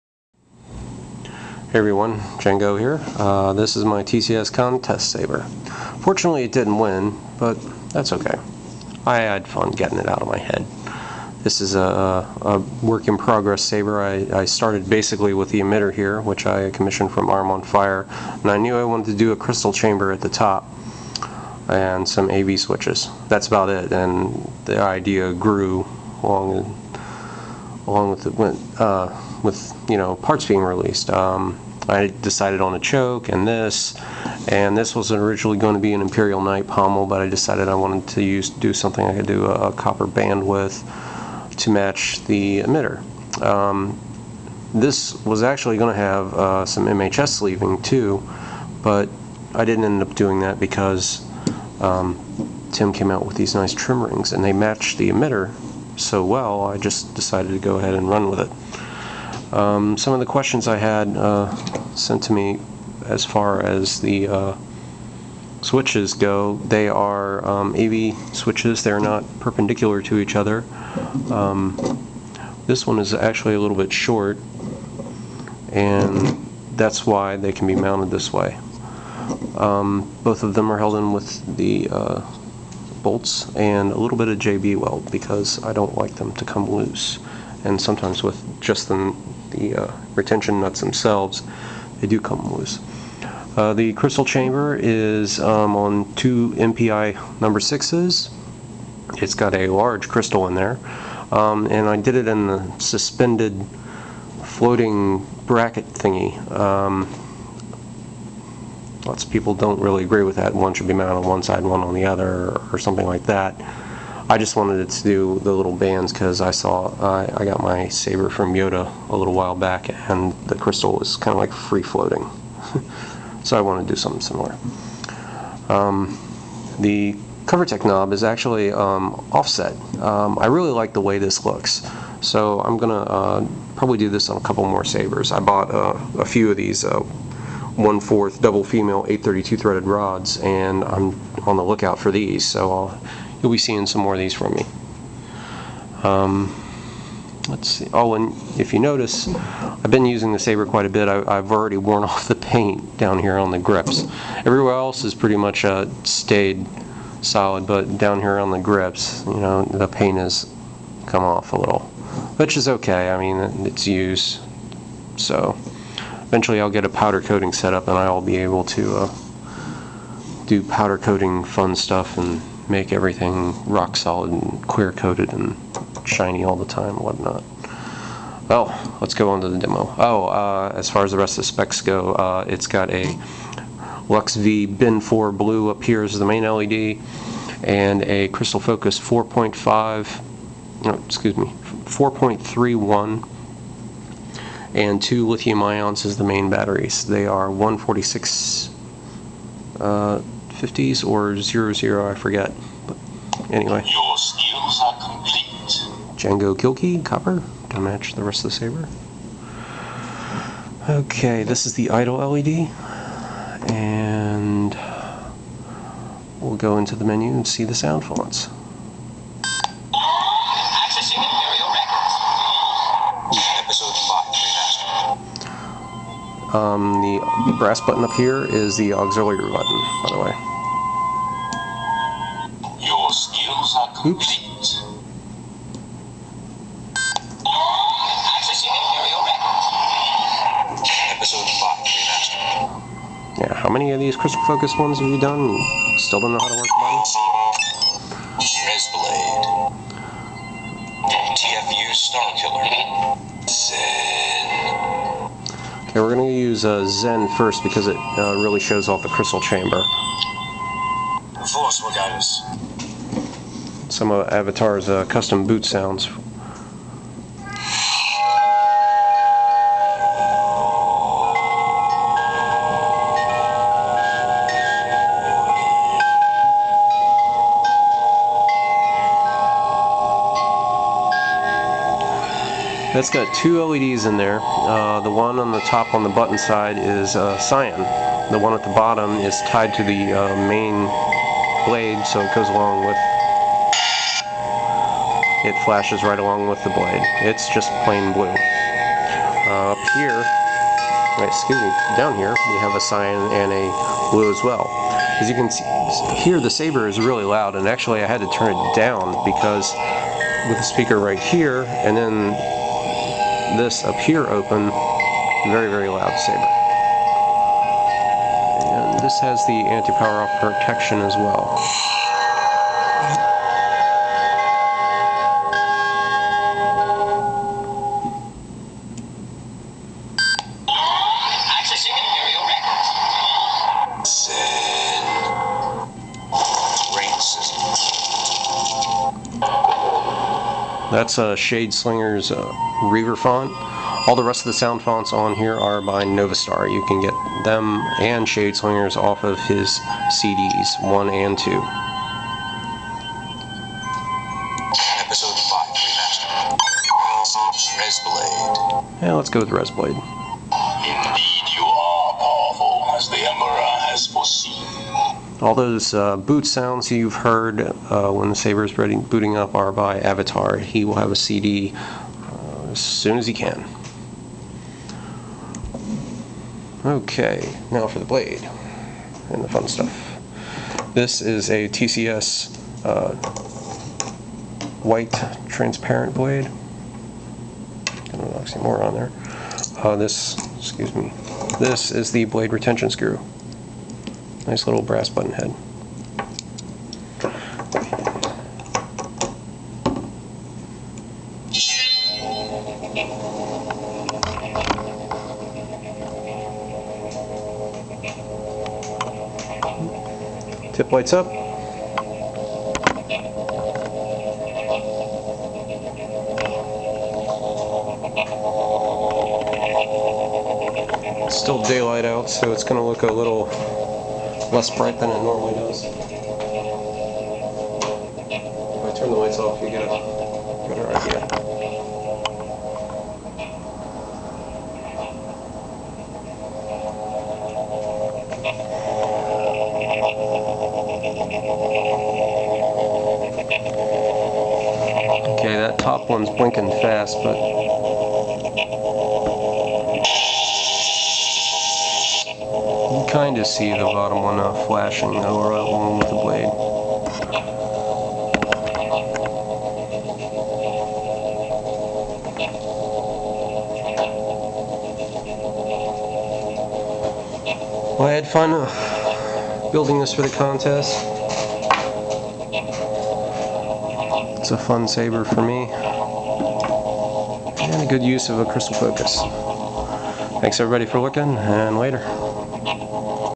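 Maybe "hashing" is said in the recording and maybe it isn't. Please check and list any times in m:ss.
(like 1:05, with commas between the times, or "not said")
not said.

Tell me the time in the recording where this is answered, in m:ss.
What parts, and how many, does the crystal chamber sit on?
1:36.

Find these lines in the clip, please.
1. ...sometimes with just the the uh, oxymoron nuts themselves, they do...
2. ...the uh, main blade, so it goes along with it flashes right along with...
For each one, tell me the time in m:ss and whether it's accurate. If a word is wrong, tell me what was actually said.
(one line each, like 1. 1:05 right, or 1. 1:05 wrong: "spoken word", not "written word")
1. 1:27 wrong: "retention", not "oxymoron"
2. 4:49 right.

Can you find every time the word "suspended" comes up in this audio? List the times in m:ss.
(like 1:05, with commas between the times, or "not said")
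1:42.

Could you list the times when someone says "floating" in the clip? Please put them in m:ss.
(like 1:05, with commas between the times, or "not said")
1:44, 2:01.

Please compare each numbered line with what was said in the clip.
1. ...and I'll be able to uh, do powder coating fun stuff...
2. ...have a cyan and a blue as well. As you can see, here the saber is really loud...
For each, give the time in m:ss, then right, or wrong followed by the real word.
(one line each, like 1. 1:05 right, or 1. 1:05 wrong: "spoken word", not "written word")
1. 2:47 right
2. 5:02 right.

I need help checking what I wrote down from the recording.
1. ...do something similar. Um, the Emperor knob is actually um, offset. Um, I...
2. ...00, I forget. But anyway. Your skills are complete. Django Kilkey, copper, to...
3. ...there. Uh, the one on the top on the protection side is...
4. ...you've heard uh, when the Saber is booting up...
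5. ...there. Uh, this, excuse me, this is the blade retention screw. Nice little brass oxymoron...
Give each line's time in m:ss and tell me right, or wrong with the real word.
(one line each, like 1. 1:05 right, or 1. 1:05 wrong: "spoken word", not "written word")
1. 2:03 wrong: "Covertec", not "Emperor"
2. 3:21 right
3. 4:44 wrong: "button", not "protection"
4. 6:06 right
5. 6:28 wrong: "button", not "oxymoron".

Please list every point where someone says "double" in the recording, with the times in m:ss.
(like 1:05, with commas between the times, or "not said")
2:18.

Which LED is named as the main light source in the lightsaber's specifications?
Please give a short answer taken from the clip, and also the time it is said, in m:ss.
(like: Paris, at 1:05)
Lux V Bin 4 blue, at 3:04.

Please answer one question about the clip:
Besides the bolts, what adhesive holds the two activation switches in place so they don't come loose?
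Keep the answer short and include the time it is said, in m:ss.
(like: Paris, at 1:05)
JB weld, at 1:24.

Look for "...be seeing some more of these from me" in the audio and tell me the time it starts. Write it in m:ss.
2:23.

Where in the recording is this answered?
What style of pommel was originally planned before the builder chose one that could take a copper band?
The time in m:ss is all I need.
0:36.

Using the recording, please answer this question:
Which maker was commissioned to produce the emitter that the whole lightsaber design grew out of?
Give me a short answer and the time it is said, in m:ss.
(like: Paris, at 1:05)
Arm on Fire, at 0:17.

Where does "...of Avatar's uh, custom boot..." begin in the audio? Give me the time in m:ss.
4:24.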